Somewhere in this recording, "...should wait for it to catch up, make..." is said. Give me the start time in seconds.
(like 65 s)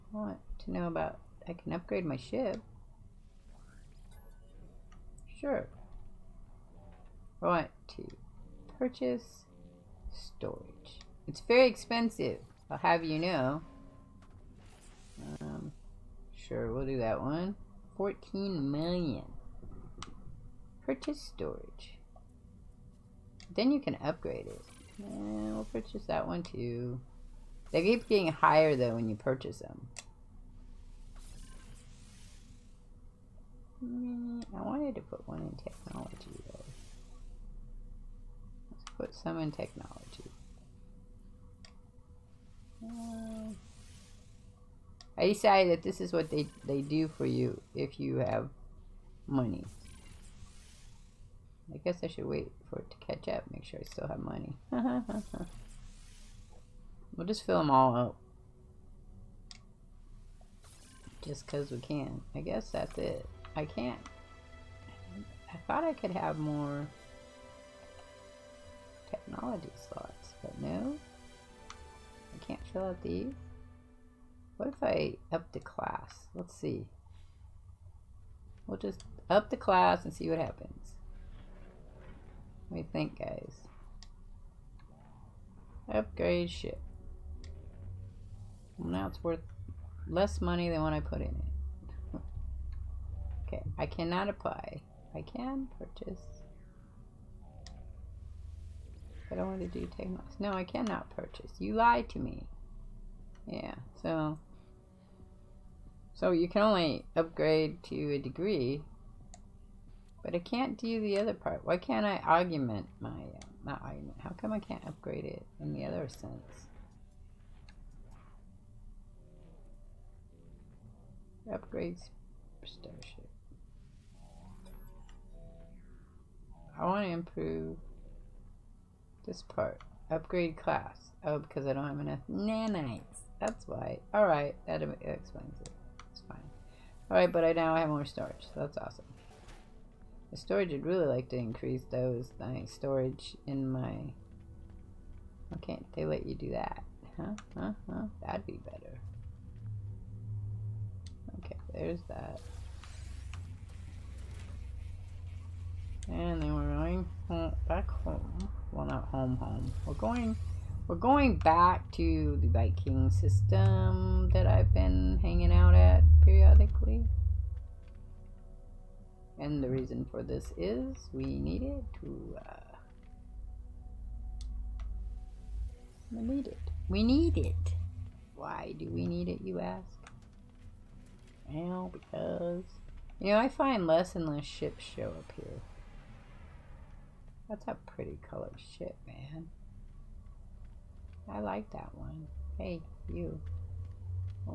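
52 s.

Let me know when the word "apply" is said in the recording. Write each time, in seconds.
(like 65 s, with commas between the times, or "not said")
94 s.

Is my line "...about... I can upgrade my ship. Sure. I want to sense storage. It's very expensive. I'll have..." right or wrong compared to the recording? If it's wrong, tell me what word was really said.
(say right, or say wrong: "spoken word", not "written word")
wrong: "purchase", not "sense".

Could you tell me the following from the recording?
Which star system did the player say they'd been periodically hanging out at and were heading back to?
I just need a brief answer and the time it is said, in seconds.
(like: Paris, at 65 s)
Viking system, at 162 s.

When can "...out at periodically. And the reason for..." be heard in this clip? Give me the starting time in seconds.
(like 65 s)
165 s.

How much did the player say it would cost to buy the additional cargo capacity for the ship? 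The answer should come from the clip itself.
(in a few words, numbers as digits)
14 million.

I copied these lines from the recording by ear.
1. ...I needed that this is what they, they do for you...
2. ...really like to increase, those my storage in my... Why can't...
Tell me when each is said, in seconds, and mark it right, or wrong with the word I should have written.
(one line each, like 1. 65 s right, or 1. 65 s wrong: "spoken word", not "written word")
1. 45 s wrong: "decided", not "needed"
2. 140 s right.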